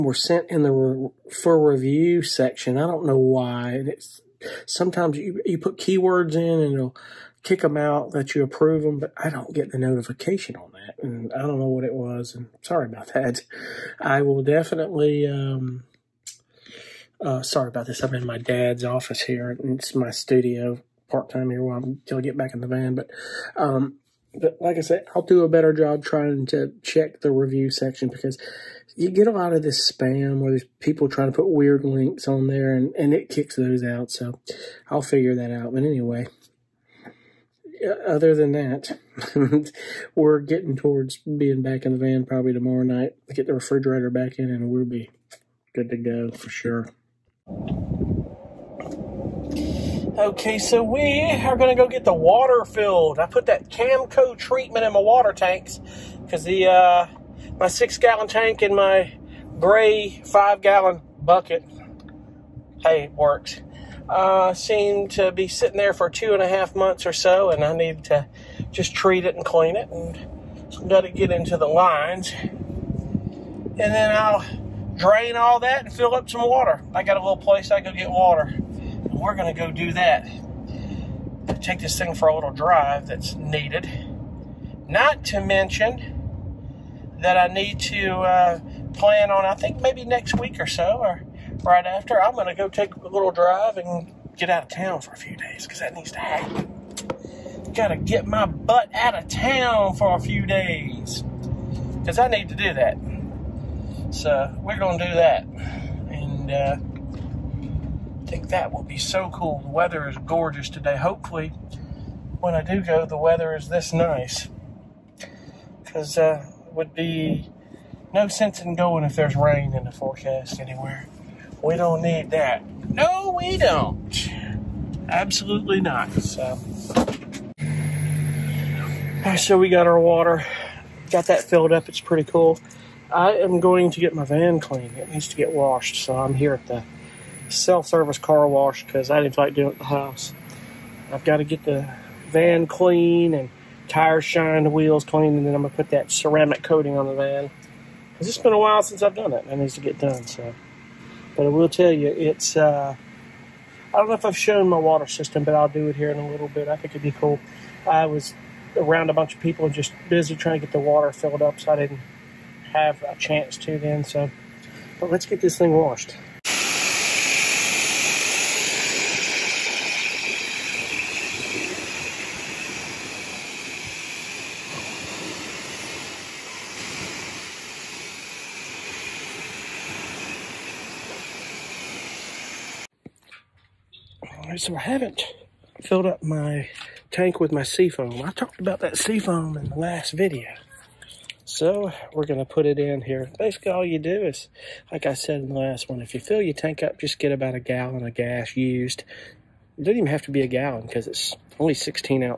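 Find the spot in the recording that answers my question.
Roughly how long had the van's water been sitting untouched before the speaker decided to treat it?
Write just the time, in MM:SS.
01:06.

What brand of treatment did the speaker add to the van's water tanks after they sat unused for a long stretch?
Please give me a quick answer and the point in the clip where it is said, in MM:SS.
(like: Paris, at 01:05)
Camco, at 00:53.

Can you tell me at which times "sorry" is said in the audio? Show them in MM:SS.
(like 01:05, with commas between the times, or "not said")
00:12, 00:17.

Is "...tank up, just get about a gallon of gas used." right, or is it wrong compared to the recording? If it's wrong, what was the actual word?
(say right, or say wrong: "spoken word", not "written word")
right.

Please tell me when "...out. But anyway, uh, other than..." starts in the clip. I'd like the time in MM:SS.
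00:35.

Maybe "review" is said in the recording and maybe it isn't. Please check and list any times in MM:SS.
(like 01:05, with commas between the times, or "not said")
00:01, 00:27.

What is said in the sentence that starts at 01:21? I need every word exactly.
Take this thing for a little drive that's needed.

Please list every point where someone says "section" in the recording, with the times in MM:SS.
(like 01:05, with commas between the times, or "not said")
00:02, 00:27.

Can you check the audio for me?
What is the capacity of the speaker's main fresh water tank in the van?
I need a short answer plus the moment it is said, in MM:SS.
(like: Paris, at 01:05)
6 gallons, at 00:57.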